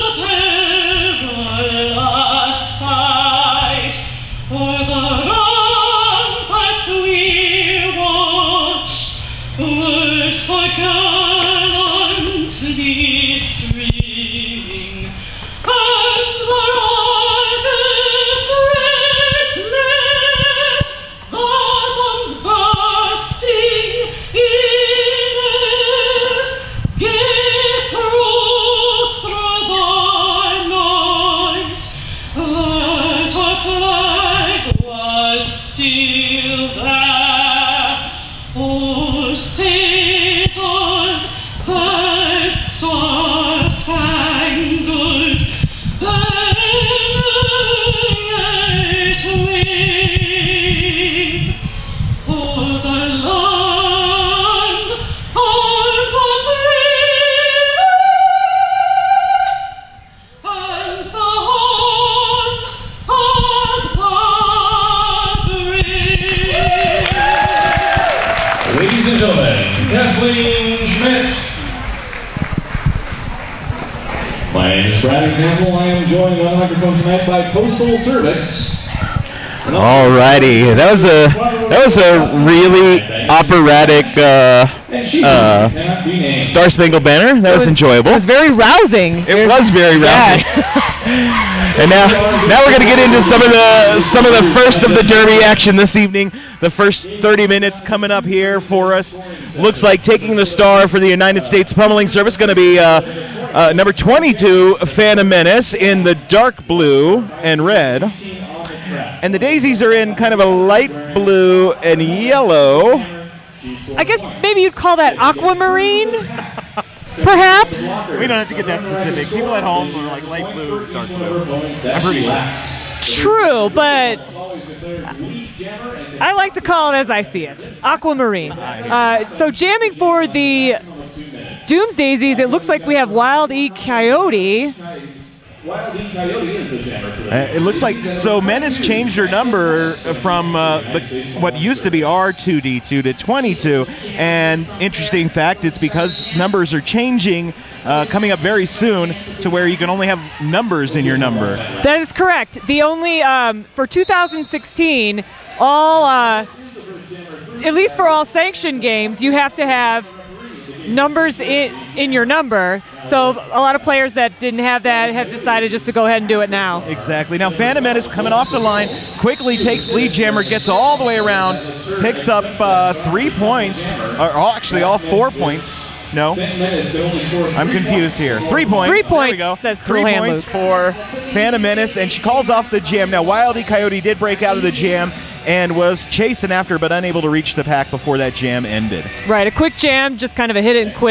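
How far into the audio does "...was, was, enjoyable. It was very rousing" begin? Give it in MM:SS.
01:27.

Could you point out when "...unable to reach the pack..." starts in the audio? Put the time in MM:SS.
03:06.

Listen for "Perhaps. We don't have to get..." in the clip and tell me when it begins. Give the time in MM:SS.
01:57.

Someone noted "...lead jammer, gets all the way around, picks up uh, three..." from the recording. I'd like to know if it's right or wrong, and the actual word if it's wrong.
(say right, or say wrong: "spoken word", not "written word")
right.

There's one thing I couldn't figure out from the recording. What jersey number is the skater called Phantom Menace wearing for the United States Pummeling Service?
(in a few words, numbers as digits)
22.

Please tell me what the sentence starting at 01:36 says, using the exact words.
The first 30 minutes coming up here for us.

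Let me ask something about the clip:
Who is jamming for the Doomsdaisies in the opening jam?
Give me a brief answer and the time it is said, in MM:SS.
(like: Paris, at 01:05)
Wild E Coyote, at 02:13.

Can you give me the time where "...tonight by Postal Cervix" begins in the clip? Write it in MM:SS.
01:16.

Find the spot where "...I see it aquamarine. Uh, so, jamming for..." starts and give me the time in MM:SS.
02:07.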